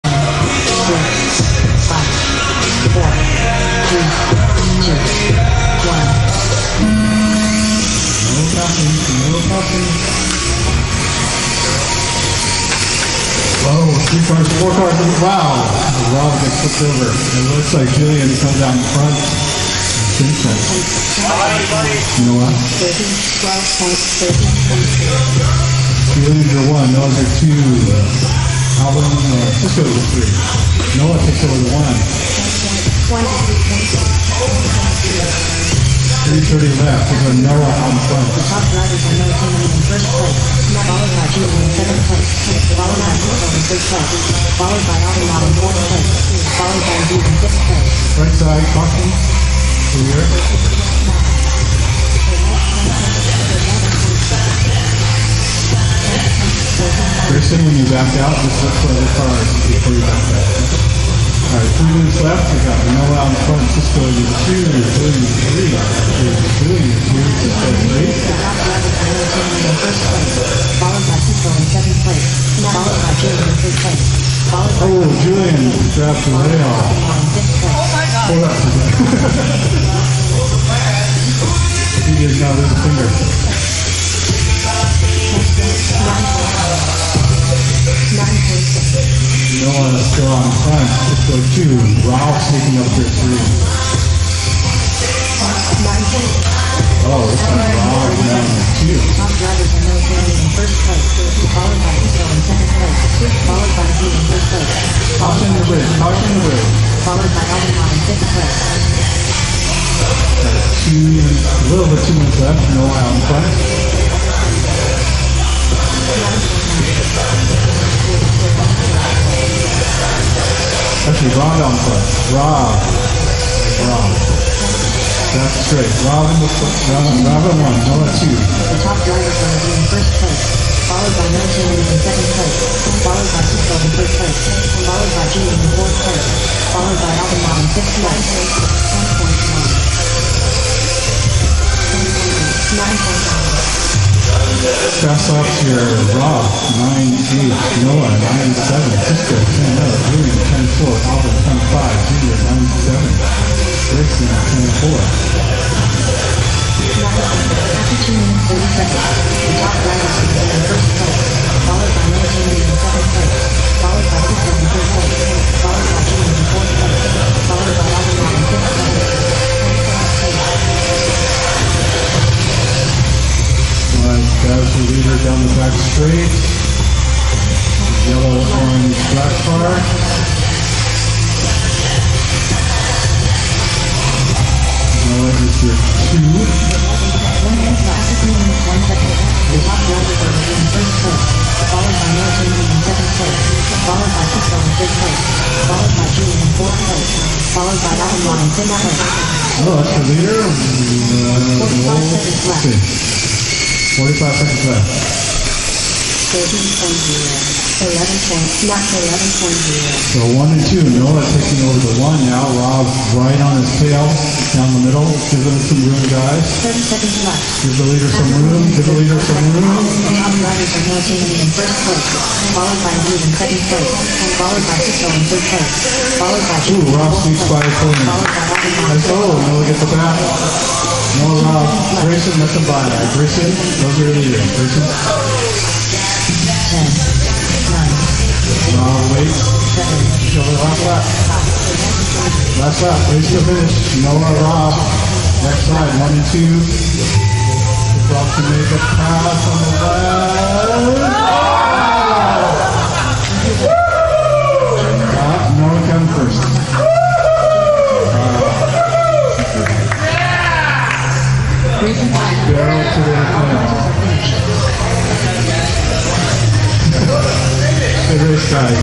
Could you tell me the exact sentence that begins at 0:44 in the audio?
Followed by Adelman in fourth place.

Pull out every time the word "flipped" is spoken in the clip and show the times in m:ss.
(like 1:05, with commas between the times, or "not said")
0:16.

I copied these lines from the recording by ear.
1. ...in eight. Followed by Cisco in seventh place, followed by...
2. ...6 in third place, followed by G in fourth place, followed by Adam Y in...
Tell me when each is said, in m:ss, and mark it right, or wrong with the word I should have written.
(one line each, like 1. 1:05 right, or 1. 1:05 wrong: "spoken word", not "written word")
1. 1:07 right
2. 3:14 right.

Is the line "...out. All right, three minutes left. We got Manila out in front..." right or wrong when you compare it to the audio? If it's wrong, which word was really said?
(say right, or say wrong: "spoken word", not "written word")
right.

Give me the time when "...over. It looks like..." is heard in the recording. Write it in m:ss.
0:16.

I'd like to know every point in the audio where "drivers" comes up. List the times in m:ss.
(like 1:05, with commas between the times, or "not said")
0:38, 1:39, 2:09.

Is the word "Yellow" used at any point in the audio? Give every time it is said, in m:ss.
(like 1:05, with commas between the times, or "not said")
2:58, 3:05.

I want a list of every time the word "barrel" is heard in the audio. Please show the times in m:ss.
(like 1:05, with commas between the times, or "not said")
4:22.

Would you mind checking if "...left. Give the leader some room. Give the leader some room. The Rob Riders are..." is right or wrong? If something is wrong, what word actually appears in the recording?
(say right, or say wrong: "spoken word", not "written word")
right.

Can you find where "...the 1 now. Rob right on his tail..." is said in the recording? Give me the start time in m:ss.
3:31.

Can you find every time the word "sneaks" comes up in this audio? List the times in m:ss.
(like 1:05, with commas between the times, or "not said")
3:47.